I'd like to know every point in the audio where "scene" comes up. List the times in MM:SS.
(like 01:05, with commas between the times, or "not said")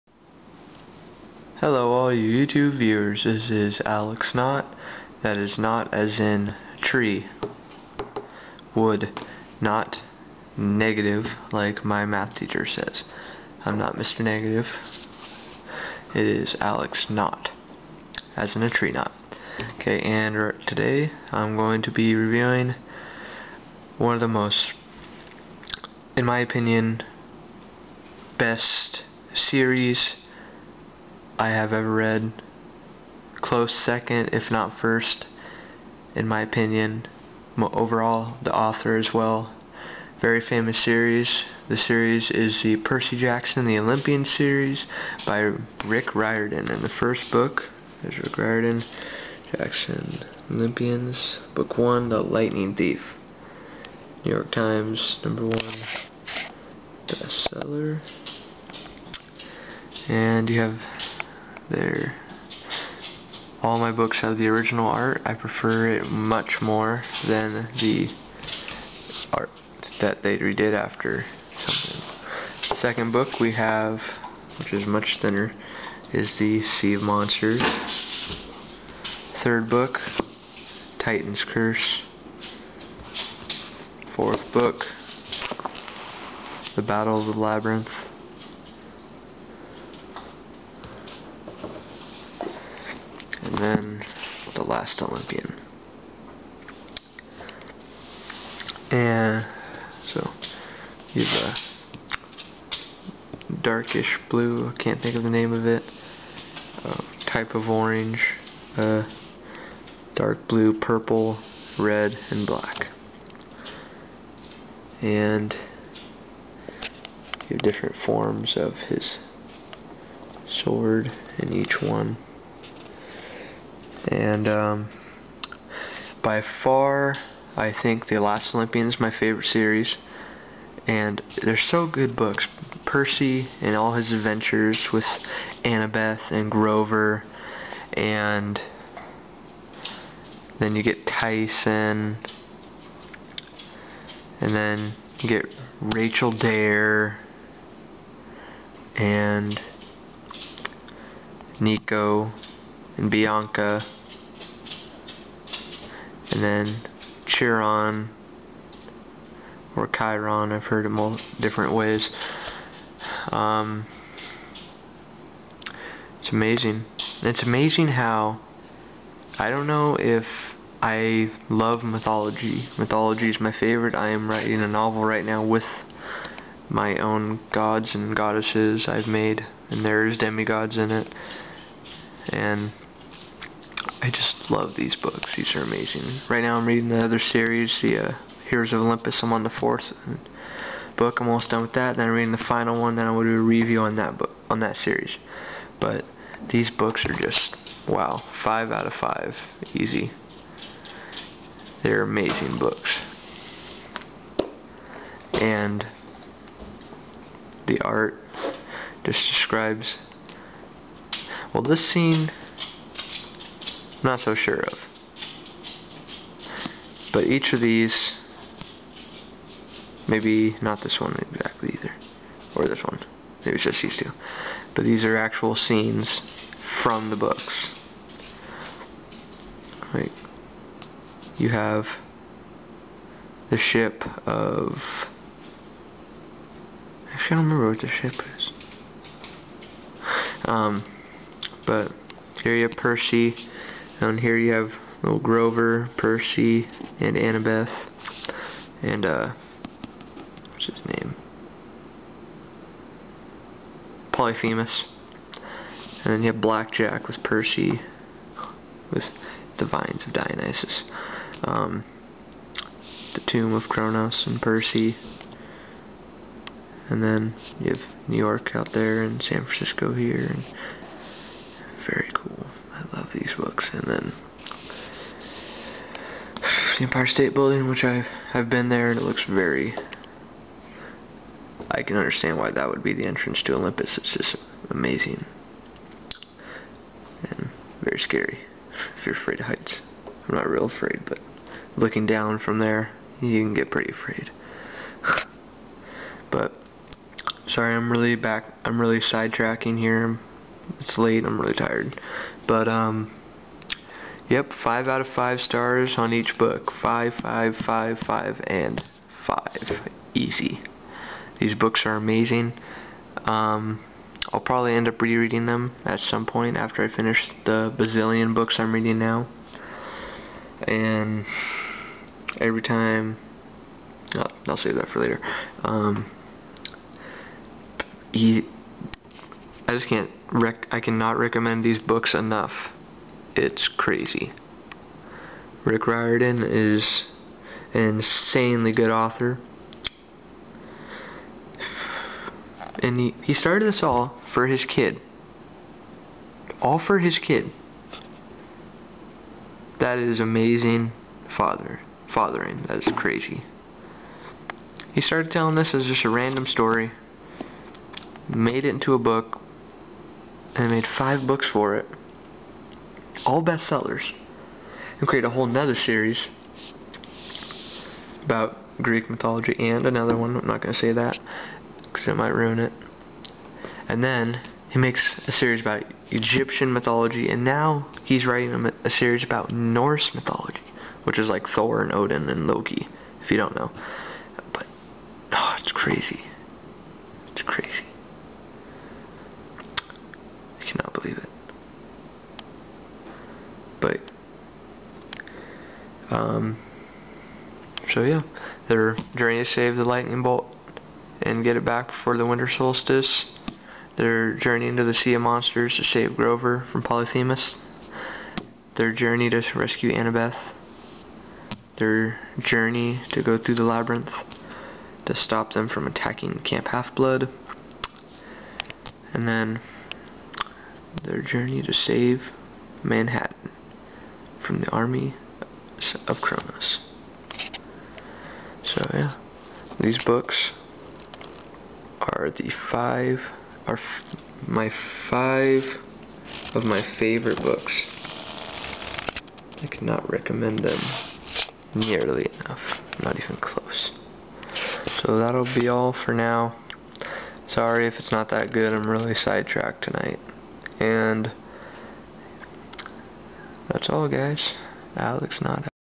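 03:31, 03:45.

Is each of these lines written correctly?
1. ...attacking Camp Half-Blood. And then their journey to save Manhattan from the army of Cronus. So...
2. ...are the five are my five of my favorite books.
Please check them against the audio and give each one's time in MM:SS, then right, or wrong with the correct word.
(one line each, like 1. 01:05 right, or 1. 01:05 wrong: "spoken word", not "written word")
1. 06:55 right
2. 07:11 right.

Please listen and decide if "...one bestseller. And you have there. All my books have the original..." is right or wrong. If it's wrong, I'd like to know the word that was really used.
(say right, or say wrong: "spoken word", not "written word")
right.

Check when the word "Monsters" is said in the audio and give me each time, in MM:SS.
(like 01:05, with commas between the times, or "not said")
01:17, 06:45.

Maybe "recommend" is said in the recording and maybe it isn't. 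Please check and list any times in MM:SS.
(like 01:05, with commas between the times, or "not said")
05:31, 07:20.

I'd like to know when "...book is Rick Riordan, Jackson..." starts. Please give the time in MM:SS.
00:47.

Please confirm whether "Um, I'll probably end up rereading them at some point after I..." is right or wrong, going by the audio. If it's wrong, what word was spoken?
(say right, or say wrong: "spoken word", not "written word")
right.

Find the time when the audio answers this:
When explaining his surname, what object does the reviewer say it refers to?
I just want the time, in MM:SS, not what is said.
00:18.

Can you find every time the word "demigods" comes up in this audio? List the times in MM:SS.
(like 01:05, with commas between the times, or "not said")
03:00.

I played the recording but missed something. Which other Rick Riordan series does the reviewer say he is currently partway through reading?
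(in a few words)
Heroes of Olympus.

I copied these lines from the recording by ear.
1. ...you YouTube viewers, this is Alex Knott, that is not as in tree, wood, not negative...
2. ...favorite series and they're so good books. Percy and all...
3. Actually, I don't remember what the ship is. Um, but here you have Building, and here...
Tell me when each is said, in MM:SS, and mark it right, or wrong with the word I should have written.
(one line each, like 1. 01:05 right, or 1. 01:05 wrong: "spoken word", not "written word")
1. 00:02 right
2. 02:09 right
3. 03:57 wrong: "Percy", not "Building".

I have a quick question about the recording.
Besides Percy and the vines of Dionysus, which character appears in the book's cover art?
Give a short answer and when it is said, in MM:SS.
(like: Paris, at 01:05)
Blackjack, at 04:16.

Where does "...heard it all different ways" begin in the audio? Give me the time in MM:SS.
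02:40.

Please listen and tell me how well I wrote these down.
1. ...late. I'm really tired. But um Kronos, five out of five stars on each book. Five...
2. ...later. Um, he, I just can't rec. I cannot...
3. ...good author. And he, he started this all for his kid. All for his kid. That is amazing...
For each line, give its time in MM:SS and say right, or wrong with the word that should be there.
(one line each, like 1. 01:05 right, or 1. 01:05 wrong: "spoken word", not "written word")
1. 05:00 wrong: "Yep", not "Kronos"
2. 05:25 right
3. 05:38 right.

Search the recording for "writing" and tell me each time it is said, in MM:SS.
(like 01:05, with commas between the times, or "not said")
02:54, 06:18.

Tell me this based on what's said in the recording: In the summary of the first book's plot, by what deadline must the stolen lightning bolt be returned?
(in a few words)
the winter solstice.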